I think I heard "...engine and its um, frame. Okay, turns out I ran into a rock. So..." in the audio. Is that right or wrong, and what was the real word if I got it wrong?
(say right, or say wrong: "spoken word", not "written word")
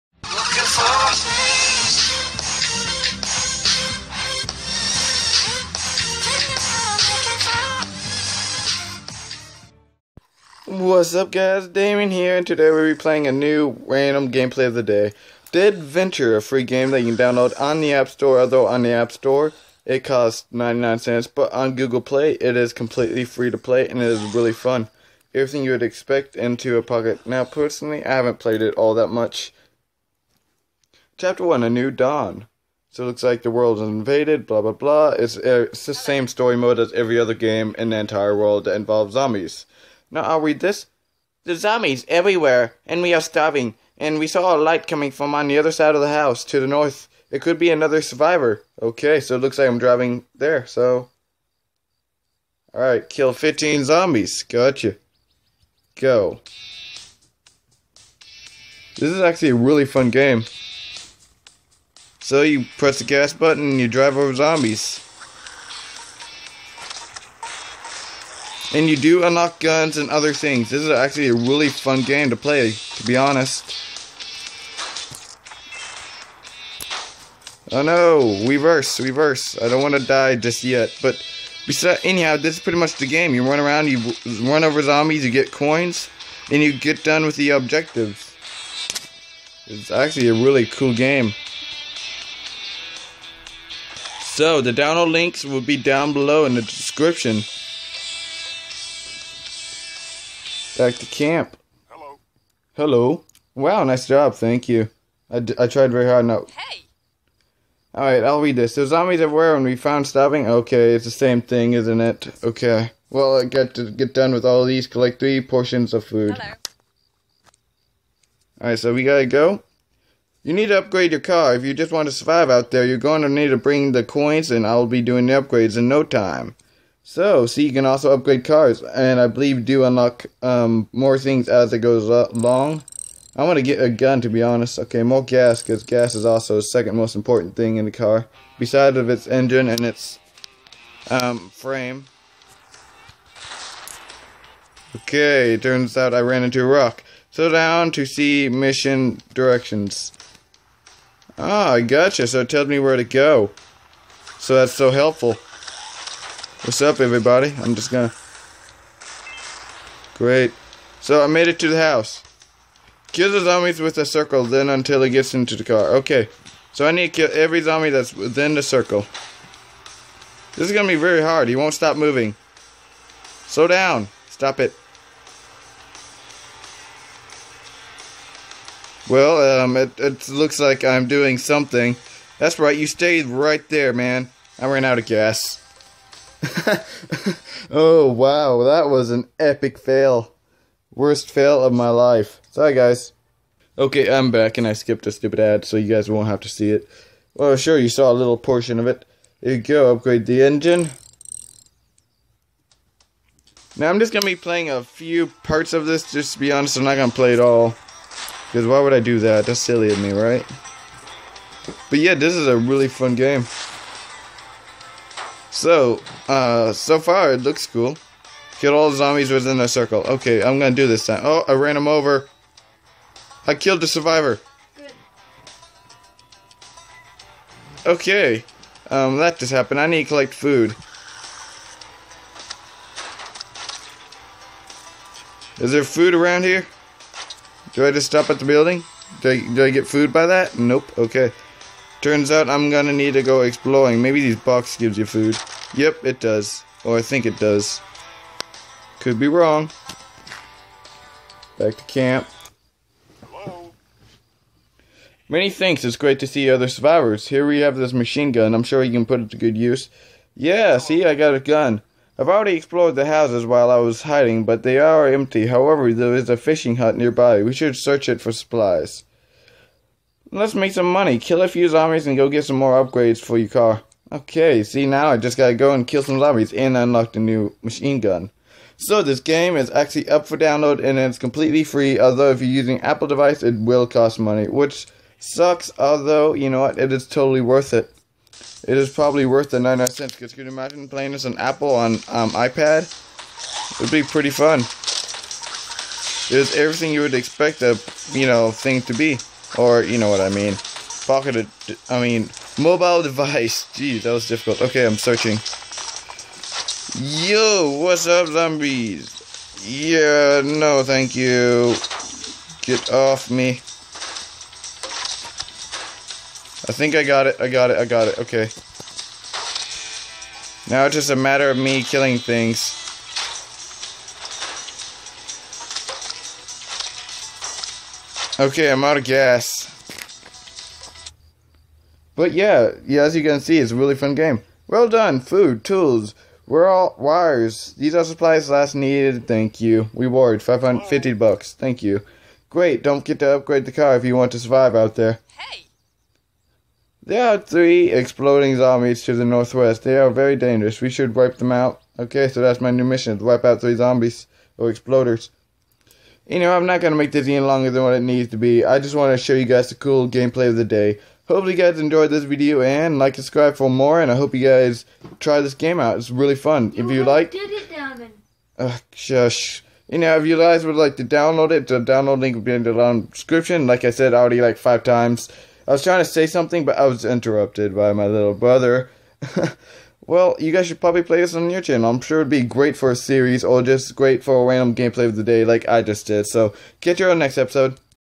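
right.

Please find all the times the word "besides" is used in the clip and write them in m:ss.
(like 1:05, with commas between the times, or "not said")
1:21, 2:18.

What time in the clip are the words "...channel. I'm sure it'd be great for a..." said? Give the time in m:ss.
6:21.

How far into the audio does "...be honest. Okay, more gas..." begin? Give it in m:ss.
2:14.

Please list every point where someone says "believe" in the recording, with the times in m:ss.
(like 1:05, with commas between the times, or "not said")
2:09.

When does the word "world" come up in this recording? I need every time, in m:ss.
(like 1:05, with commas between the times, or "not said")
0:33, 0:38.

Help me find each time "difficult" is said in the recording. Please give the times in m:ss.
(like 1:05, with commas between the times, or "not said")
5:04.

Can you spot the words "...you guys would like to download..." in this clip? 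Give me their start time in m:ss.
6:10.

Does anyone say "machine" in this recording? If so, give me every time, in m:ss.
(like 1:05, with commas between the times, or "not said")
4:17, 4:37.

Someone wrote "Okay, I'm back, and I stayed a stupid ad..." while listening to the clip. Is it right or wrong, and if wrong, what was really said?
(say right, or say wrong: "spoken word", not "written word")
wrong: "skipped", not "stayed".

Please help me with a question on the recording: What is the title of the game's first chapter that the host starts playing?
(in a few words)
A New Dawn.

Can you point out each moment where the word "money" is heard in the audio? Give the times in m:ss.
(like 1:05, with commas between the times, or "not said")
4:30, 4:44.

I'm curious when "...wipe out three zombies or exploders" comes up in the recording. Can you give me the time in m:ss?
5:53.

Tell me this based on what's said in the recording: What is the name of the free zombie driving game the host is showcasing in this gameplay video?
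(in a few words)
Dead Venture.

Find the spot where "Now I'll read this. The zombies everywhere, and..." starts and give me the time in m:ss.
0:40.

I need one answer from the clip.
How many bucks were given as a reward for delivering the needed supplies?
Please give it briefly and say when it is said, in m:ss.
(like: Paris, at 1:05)
550, at 5:40.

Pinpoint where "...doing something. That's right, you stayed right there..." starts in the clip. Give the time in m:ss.
3:01.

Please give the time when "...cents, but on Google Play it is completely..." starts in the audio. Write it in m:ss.
0:20.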